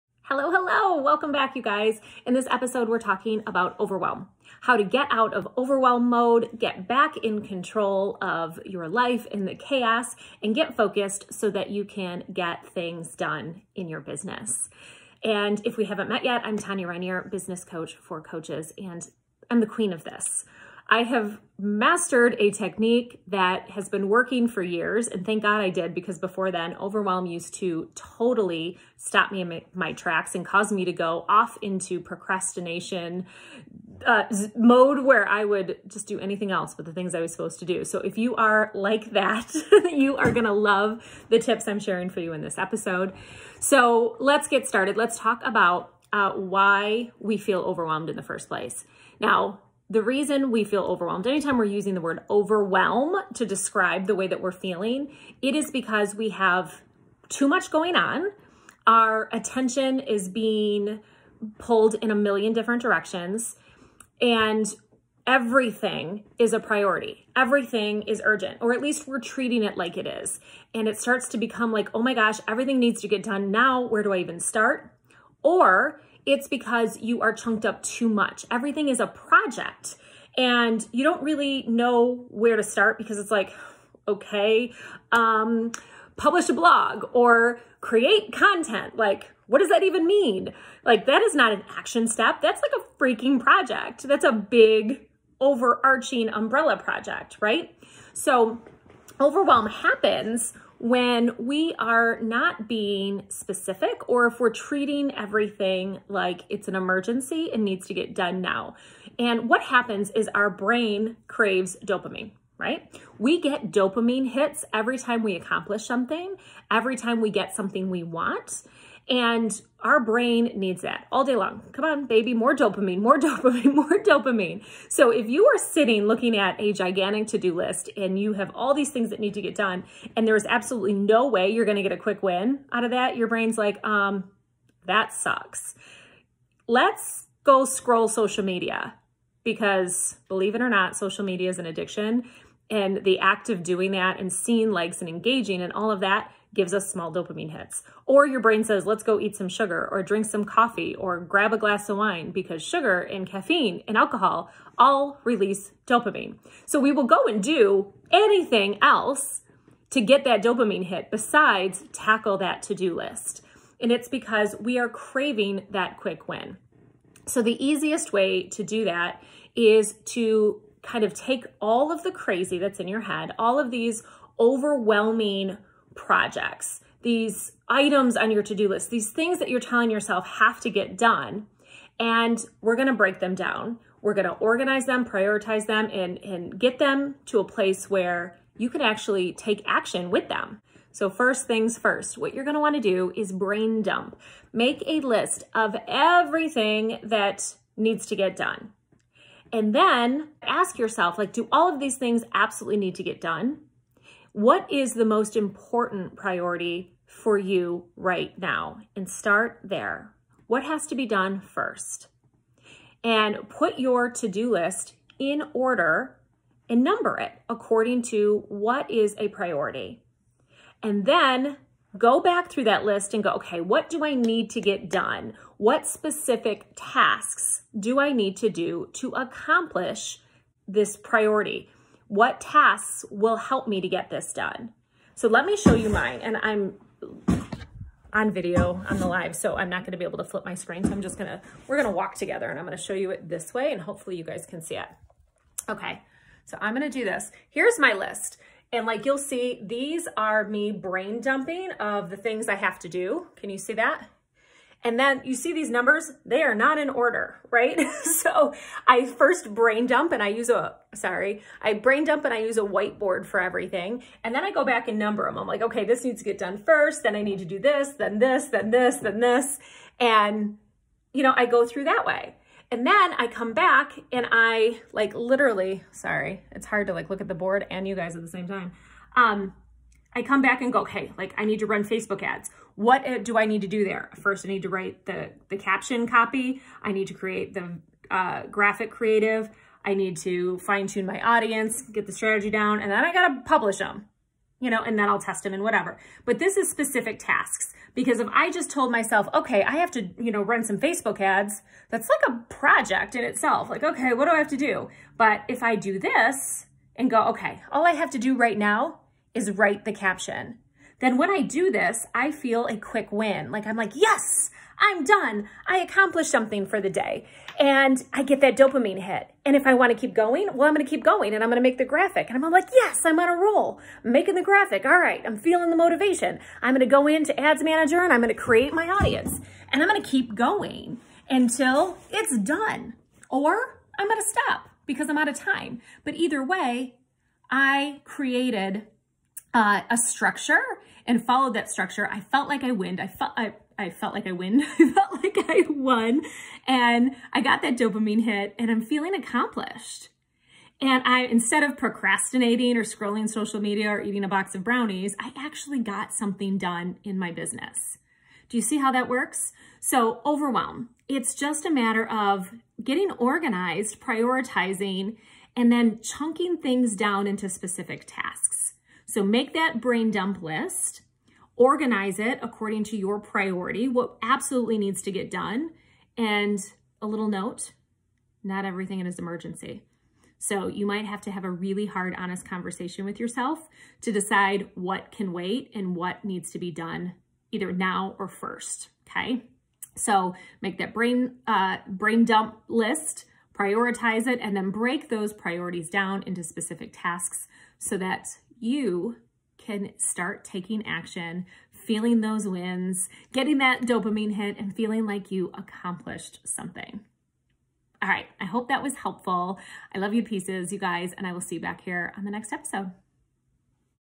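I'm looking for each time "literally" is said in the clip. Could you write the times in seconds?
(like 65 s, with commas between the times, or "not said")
275 s.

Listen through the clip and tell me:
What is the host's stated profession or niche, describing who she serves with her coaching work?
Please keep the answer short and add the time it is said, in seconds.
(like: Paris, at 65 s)
business coach for coaches, at 17 s.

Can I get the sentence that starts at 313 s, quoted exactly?
Like I'm like, yes, I'm done.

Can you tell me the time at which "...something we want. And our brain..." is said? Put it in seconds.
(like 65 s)
117 s.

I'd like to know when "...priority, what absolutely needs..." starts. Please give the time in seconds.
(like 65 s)
373 s.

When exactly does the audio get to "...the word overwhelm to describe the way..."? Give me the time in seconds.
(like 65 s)
51 s.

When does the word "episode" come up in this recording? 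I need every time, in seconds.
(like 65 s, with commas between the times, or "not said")
2 s, 42 s, 412 s.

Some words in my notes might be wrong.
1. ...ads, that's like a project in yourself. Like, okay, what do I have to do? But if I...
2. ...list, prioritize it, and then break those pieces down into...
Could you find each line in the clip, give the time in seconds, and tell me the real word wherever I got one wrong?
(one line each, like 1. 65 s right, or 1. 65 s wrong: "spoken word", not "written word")
1. 301 s wrong: "itself", not "yourself"
2. 392 s wrong: "priorities", not "pieces".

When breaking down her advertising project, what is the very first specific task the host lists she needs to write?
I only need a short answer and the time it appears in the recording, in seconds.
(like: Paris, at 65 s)
caption copy, at 285 s.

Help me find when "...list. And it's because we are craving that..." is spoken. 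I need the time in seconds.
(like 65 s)
162 s.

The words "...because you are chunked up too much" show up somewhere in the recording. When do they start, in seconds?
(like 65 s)
76 s.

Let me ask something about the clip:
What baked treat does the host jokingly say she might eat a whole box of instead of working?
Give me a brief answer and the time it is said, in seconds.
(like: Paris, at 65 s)
brownies, at 354 s.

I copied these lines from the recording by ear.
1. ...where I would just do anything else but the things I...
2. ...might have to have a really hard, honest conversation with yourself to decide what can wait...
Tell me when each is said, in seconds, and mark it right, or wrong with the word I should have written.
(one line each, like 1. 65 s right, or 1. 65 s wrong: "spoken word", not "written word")
1. 35 s right
2. 380 s right.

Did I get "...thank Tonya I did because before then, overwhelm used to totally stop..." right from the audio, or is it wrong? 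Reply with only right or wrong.
wrong.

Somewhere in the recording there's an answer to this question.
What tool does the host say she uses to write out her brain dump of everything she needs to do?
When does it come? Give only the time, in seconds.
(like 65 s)
262 s.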